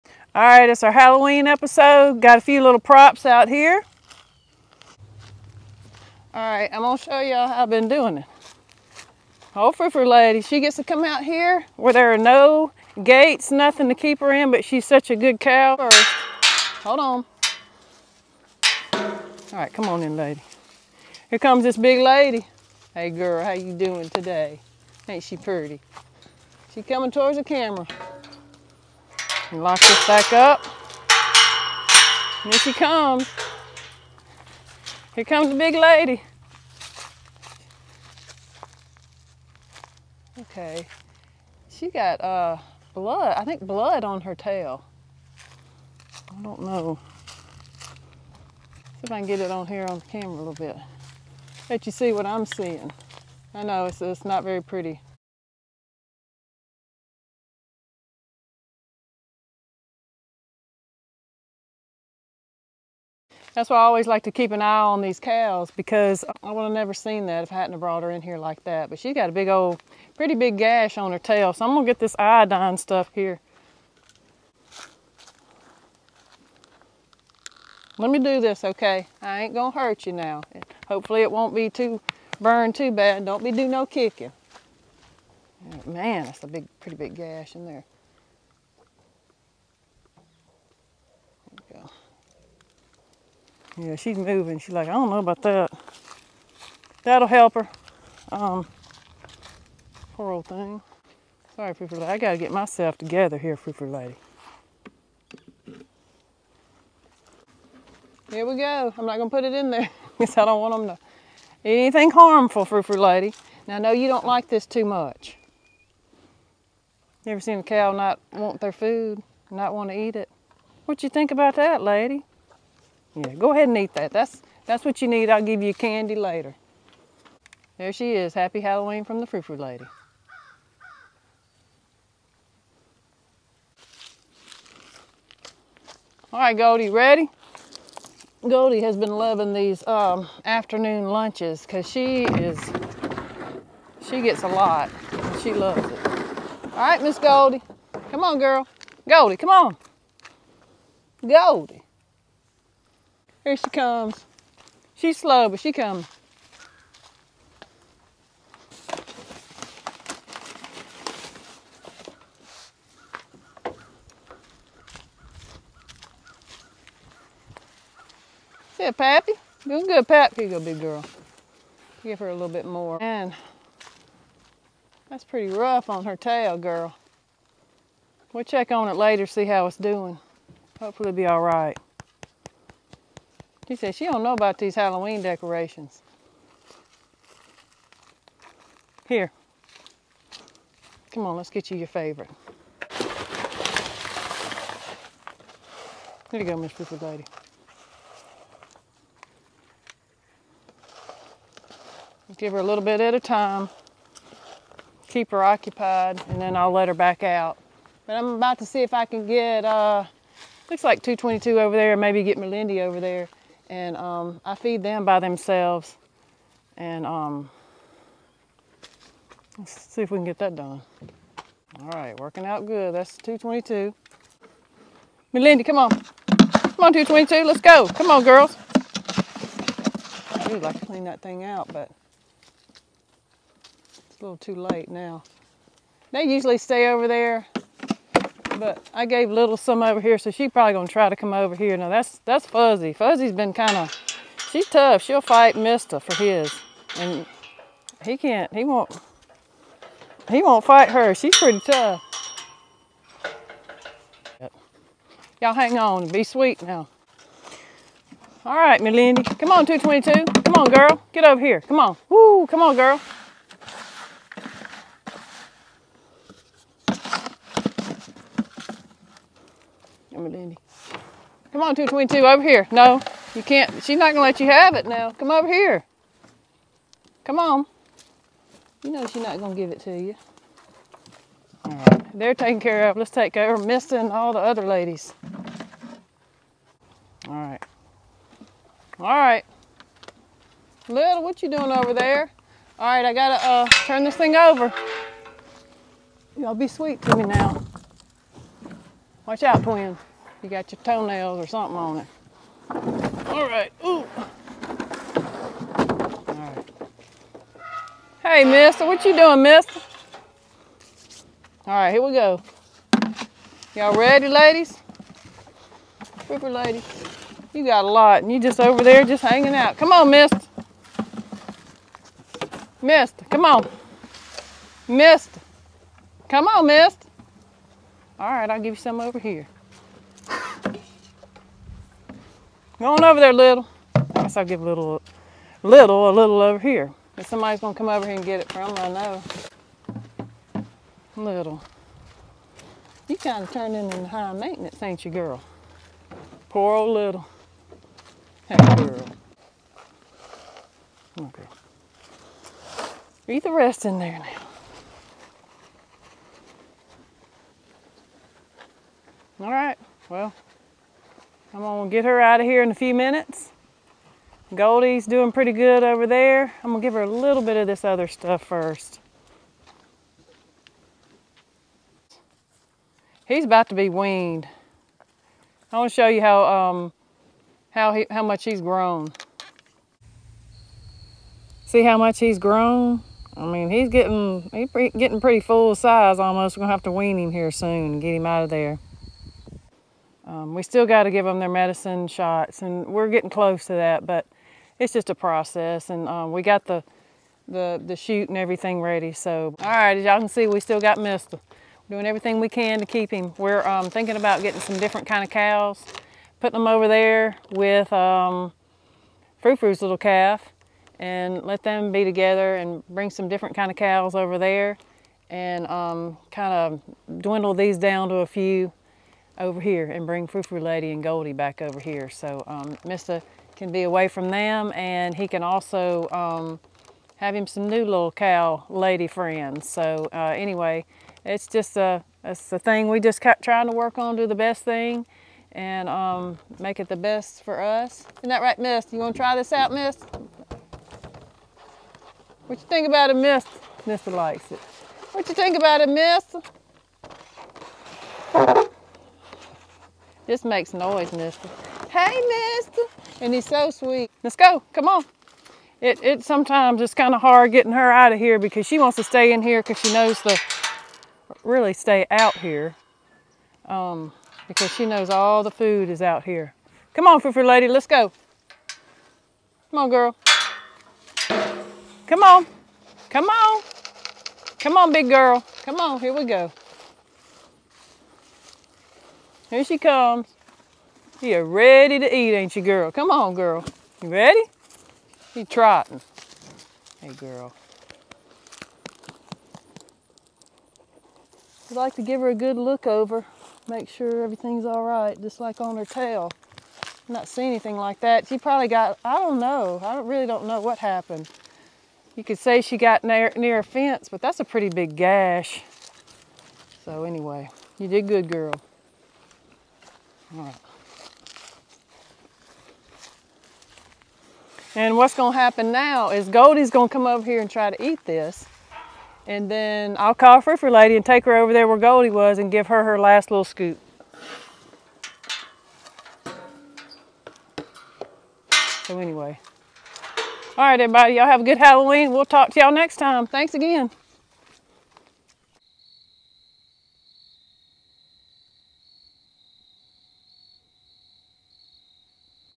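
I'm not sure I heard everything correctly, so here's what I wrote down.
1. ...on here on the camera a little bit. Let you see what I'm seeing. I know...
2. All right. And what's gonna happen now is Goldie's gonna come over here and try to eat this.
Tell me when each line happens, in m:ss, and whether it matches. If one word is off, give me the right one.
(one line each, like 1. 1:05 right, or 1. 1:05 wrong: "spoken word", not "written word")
1. 0:49 right
2. 8:30 right.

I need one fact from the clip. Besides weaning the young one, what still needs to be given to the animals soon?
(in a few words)
medicine shots.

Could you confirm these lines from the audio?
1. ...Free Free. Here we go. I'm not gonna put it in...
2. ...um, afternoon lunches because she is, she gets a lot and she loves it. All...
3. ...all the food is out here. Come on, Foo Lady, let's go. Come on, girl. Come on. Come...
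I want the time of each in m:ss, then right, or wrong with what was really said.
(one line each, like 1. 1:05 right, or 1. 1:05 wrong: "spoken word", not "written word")
1. 1:43 wrong: "Lady", not "Free"
2. 2:19 right
3. 7:45 right.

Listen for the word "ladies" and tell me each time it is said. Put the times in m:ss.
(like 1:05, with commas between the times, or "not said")
4:44, 5:14.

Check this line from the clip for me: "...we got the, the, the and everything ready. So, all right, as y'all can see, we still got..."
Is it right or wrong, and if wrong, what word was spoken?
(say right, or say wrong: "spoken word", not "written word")
right.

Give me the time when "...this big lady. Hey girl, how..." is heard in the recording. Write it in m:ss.
0:21.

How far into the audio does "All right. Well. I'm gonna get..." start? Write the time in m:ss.
5:59.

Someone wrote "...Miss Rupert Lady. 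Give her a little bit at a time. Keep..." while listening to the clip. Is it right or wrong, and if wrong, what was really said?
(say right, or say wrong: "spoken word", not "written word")
right.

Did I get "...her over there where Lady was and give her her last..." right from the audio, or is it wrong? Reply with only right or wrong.
wrong.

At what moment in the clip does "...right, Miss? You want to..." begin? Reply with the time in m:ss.
7:18.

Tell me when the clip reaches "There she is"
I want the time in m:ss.
2:07.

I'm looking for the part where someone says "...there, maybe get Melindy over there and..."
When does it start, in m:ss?
3:31.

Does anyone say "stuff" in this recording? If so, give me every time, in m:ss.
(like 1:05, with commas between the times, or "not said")
1:12, 6:08.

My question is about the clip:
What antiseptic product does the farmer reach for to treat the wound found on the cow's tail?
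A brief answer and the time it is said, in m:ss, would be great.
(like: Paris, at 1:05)
iodine, at 1:12.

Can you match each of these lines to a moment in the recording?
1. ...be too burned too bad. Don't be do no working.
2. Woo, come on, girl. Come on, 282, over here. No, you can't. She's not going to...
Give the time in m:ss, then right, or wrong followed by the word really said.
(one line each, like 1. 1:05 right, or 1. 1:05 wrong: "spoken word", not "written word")
1. 1:21 wrong: "kicking", not "working"
2. 4:22 wrong: "222", not "282".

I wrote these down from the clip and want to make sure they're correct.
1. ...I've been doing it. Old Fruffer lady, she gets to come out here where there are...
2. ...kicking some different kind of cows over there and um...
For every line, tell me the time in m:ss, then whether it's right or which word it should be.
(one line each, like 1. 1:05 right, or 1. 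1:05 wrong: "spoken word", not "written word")
1. 0:07 right
2. 6:52 wrong: "bring", not "kicking".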